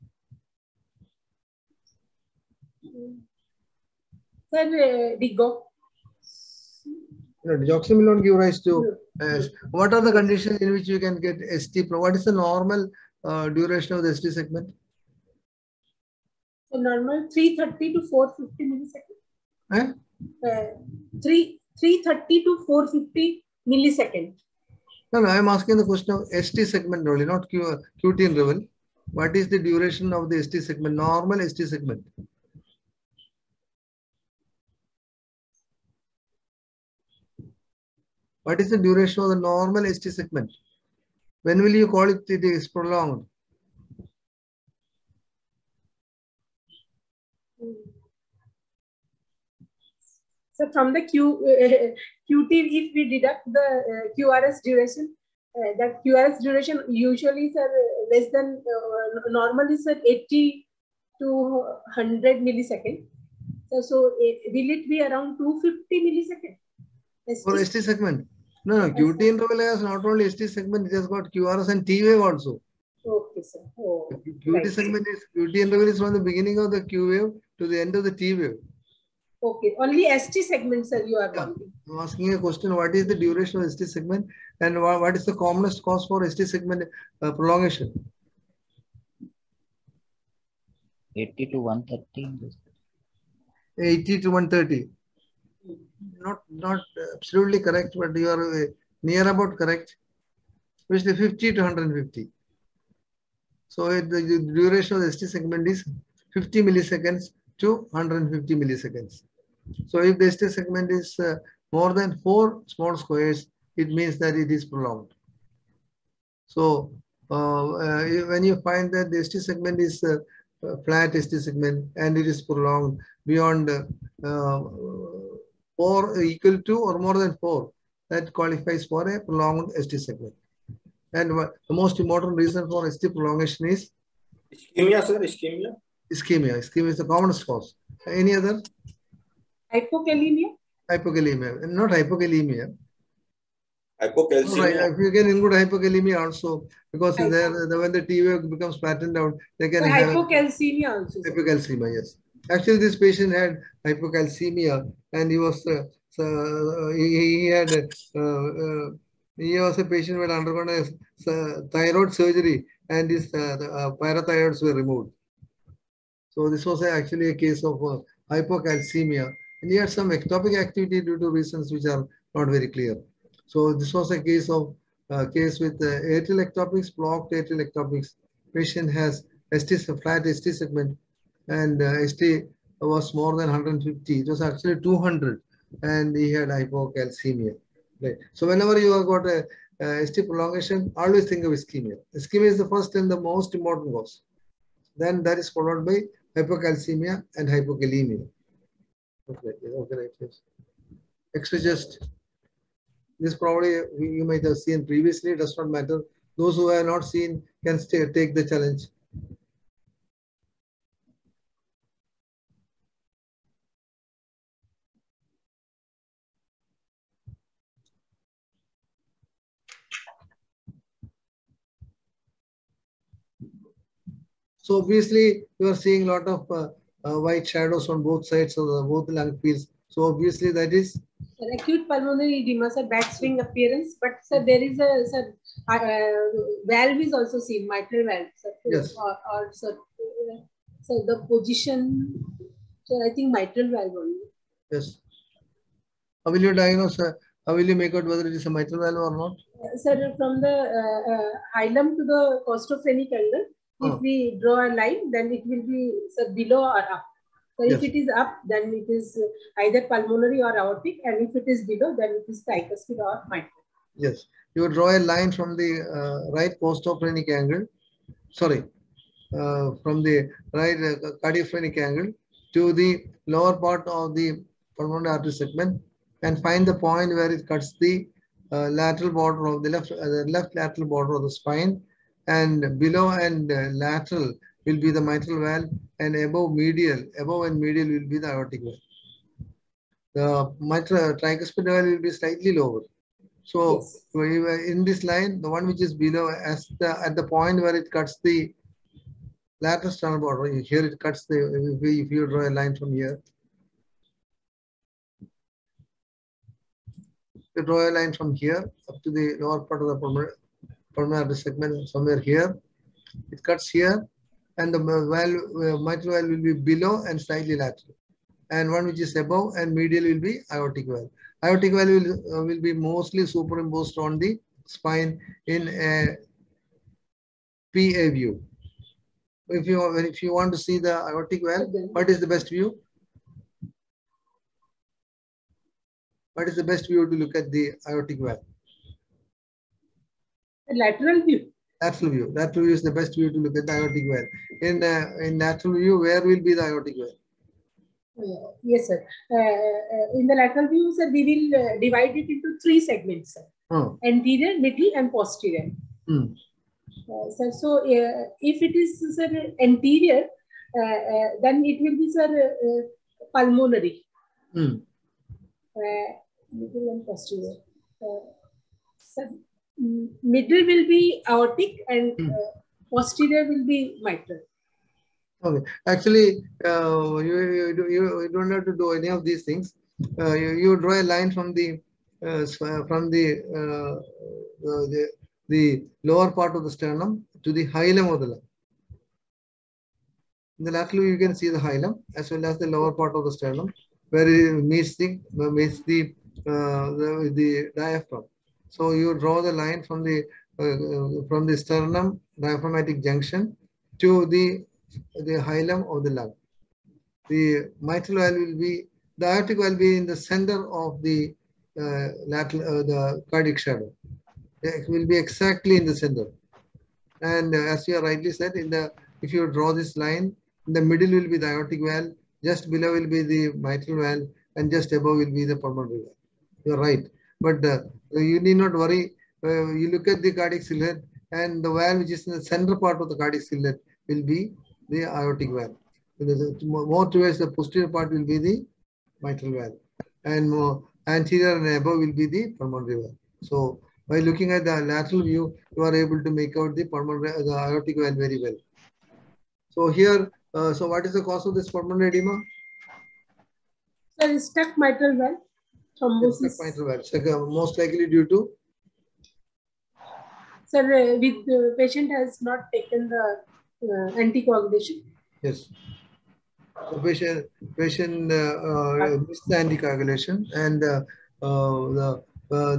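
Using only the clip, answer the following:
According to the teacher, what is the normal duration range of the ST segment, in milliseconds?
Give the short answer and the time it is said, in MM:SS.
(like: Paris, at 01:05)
50 to 150, at 01:41.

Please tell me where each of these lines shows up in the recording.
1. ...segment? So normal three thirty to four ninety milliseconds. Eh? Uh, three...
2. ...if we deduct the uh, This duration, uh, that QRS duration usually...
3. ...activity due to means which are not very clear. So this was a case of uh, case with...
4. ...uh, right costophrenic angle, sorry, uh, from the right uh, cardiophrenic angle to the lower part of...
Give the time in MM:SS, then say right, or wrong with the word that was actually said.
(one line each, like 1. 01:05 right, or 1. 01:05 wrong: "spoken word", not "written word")
1. 00:14 wrong: "fifty", not "ninety"
2. 00:52 wrong: "QRS", not "This"
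3. 02:50 wrong: "reasons", not "means"
4. 04:25 right.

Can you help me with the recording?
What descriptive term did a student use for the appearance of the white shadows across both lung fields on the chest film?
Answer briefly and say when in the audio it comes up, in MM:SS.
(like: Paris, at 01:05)
batwing appearance, at 03:52.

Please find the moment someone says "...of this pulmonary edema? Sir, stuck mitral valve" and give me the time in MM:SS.
07:31.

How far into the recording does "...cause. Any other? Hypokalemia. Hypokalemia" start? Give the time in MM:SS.
02:17.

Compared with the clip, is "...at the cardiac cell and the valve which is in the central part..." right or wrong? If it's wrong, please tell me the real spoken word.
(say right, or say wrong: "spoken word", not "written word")
right.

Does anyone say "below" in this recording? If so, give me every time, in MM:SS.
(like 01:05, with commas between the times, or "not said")
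04:16, 04:21, 04:42, 04:55, 05:16, 07:02.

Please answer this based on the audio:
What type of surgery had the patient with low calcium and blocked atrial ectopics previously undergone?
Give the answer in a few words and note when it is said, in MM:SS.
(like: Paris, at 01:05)
thyroid surgery, at 02:41.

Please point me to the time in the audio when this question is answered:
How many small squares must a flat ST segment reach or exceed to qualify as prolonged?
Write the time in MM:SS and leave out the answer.
02:07.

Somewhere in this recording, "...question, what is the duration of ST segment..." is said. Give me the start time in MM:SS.
01:22.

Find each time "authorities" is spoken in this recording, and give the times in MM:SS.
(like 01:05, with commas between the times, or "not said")
not said.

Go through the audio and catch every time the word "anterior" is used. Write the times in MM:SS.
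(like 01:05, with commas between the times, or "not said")
05:54, 05:59, 07:21.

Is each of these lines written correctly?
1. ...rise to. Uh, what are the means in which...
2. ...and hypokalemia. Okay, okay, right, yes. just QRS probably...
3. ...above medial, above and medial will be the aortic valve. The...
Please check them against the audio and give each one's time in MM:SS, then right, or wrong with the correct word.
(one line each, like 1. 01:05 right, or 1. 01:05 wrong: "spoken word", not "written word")
1. 00:08 wrong: "conditions", not "means"
2. 03:17 wrong: "This", not "QRS"
3. 04:46 right.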